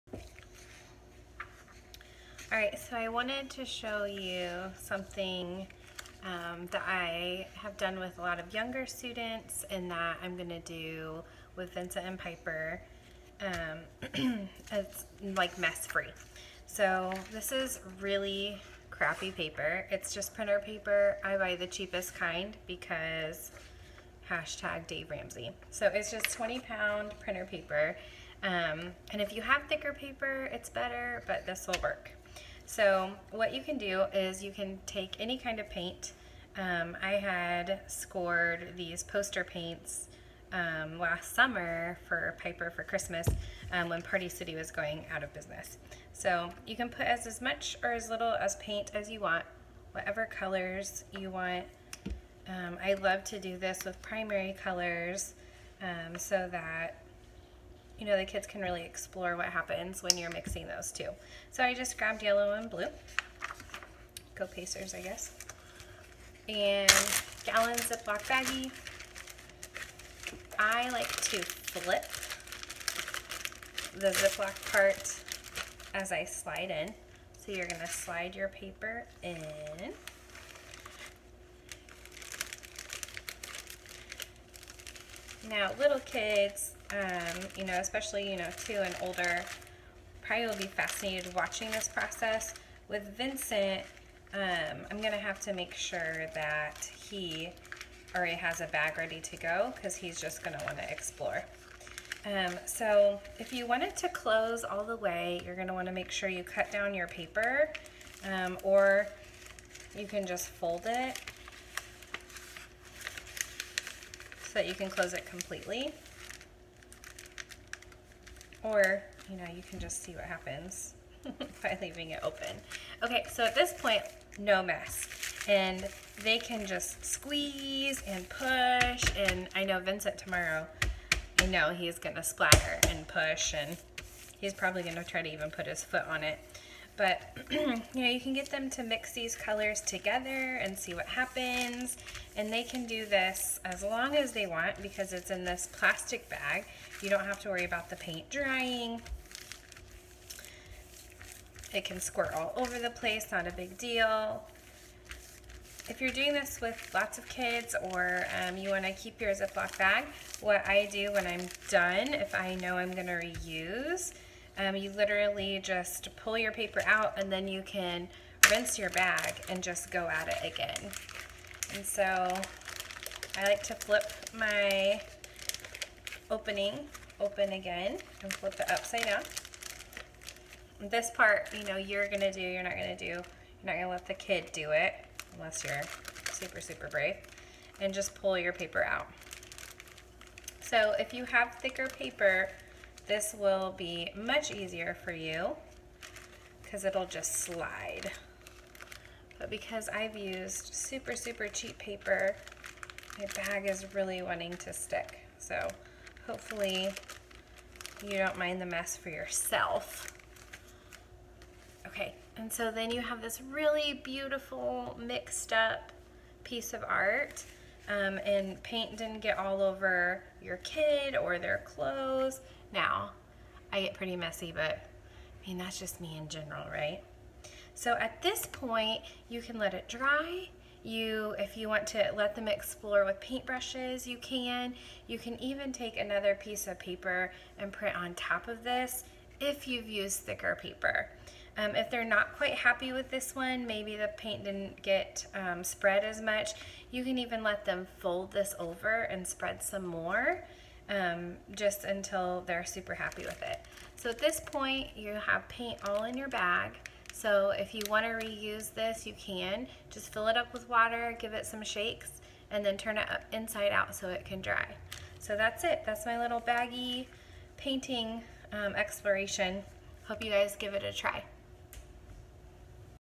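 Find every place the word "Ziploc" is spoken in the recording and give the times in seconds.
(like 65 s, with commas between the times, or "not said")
67 s, 74 s, 159 s.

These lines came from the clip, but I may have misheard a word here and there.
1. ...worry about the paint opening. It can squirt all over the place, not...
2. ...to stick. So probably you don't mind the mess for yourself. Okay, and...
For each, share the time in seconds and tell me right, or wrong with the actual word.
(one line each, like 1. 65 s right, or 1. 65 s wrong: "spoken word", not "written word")
1. 147 s wrong: "drying", not "opening"
2. 204 s wrong: "hopefully", not "probably".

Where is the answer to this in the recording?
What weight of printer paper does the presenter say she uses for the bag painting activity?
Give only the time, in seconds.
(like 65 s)
26 s.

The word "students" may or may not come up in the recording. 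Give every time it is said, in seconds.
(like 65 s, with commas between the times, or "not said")
8 s.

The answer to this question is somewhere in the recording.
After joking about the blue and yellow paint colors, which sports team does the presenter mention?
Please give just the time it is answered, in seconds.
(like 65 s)
64 s.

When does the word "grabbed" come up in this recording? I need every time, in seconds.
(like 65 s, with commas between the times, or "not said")
61 s.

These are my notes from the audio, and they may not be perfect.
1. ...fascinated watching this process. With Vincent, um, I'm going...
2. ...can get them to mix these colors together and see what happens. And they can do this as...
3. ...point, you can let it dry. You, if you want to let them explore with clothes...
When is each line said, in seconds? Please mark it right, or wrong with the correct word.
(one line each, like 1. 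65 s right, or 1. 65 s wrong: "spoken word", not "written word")
1. 90 s right
2. 138 s right
3. 228 s wrong: "paintbrushes", not "clothes".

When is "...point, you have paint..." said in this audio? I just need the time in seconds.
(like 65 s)
254 s.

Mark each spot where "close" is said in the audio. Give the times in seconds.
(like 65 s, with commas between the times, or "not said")
104 s, 114 s.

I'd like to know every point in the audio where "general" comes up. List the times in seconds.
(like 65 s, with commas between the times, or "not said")
226 s.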